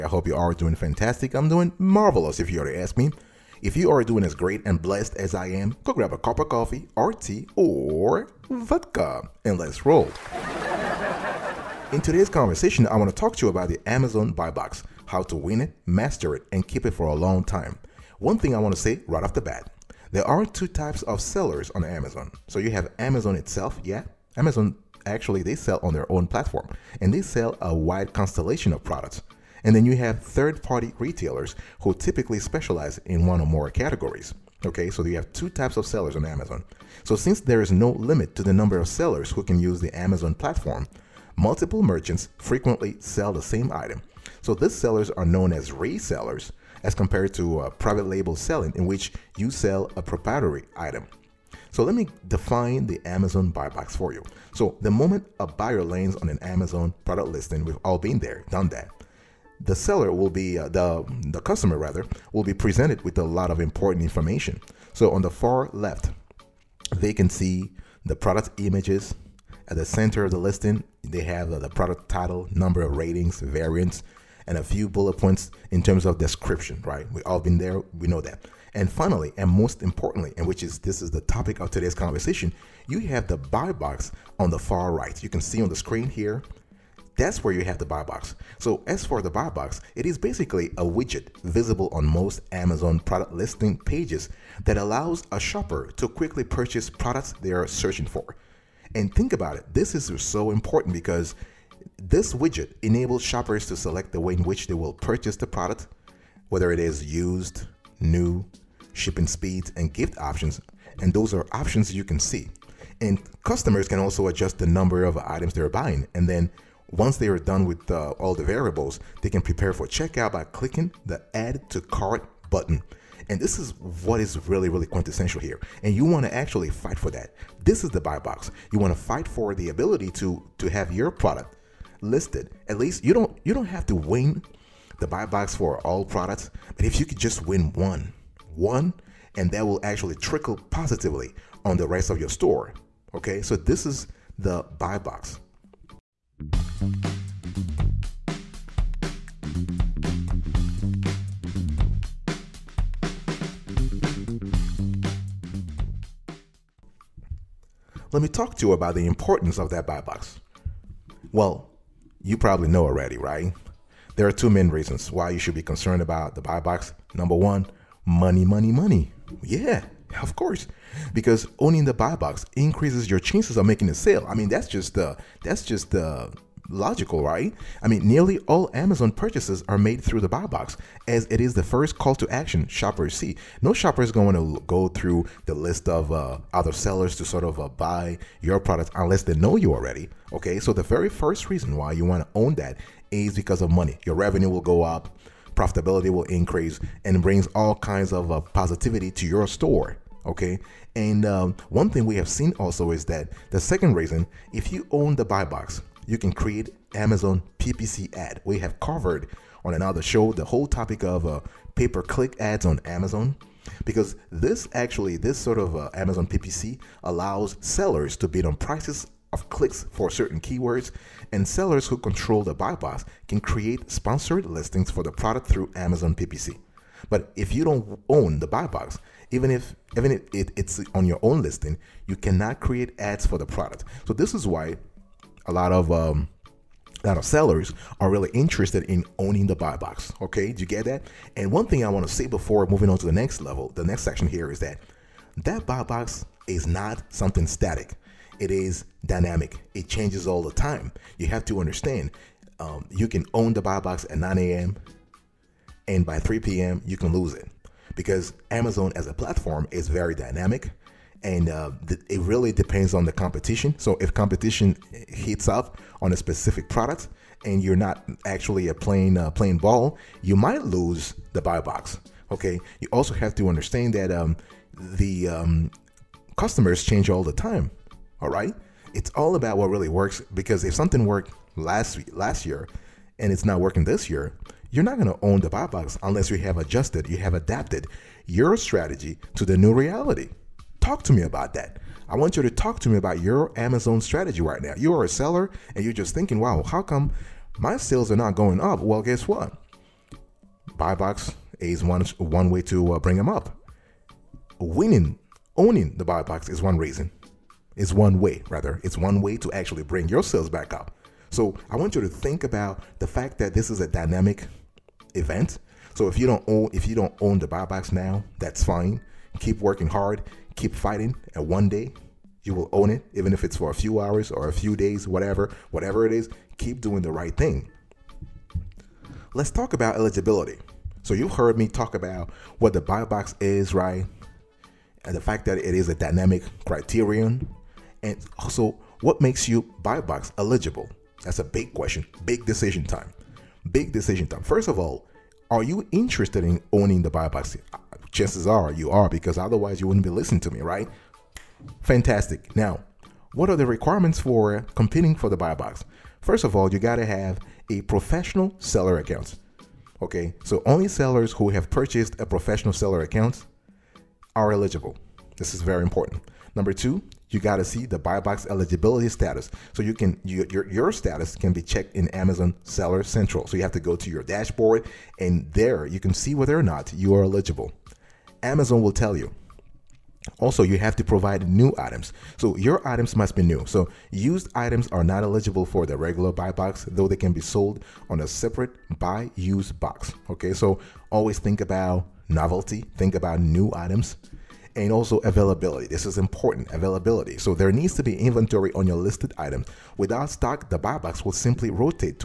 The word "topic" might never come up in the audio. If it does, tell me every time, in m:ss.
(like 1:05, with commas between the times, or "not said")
1:21, 3:30.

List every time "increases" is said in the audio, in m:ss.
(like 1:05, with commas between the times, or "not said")
2:52, 3:16.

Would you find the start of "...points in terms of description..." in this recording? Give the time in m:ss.
1:15.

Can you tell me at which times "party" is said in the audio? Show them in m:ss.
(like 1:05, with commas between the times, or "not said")
0:30.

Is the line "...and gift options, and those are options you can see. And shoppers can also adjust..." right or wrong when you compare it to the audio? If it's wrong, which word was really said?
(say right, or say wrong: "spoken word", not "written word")
wrong: "customers", not "shoppers".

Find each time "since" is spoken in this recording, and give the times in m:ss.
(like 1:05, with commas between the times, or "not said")
0:37.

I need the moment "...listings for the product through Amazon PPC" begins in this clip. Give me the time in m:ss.
3:44.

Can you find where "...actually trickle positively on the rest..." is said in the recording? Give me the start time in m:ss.
2:19.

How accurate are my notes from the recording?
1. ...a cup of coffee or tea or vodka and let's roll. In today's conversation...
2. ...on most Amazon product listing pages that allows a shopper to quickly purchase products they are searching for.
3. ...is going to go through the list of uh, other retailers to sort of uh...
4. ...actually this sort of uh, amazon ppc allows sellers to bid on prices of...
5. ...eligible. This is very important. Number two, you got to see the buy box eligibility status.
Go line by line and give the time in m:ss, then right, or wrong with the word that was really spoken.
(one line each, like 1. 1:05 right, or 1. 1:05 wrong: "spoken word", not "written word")
1. 0:06 right
2. 1:31 right
3. 3:04 wrong: "sellers", not "retailers"
4. 3:34 right
5. 6:04 right.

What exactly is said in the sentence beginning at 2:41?
Well, you probably know already, right?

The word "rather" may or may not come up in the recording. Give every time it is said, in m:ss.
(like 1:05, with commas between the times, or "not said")
1:01, 5:08.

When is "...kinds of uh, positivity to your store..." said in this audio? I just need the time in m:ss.
3:17.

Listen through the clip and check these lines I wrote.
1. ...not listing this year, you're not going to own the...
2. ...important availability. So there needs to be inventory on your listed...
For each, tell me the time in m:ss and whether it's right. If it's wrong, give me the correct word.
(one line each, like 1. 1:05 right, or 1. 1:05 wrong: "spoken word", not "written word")
1. 4:43 wrong: "working", not "listing"
2. 6:36 right.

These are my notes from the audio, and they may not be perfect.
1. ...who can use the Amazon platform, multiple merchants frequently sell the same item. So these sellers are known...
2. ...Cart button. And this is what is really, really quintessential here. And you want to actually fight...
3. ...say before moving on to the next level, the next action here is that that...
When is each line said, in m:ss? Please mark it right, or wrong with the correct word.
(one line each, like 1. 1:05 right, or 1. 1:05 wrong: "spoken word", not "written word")
1. 0:39 right
2. 2:01 right
3. 4:02 wrong: "section", not "action".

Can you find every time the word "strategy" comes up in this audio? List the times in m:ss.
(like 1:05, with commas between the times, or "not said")
4:48, 4:53.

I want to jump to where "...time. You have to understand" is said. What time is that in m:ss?
4:10.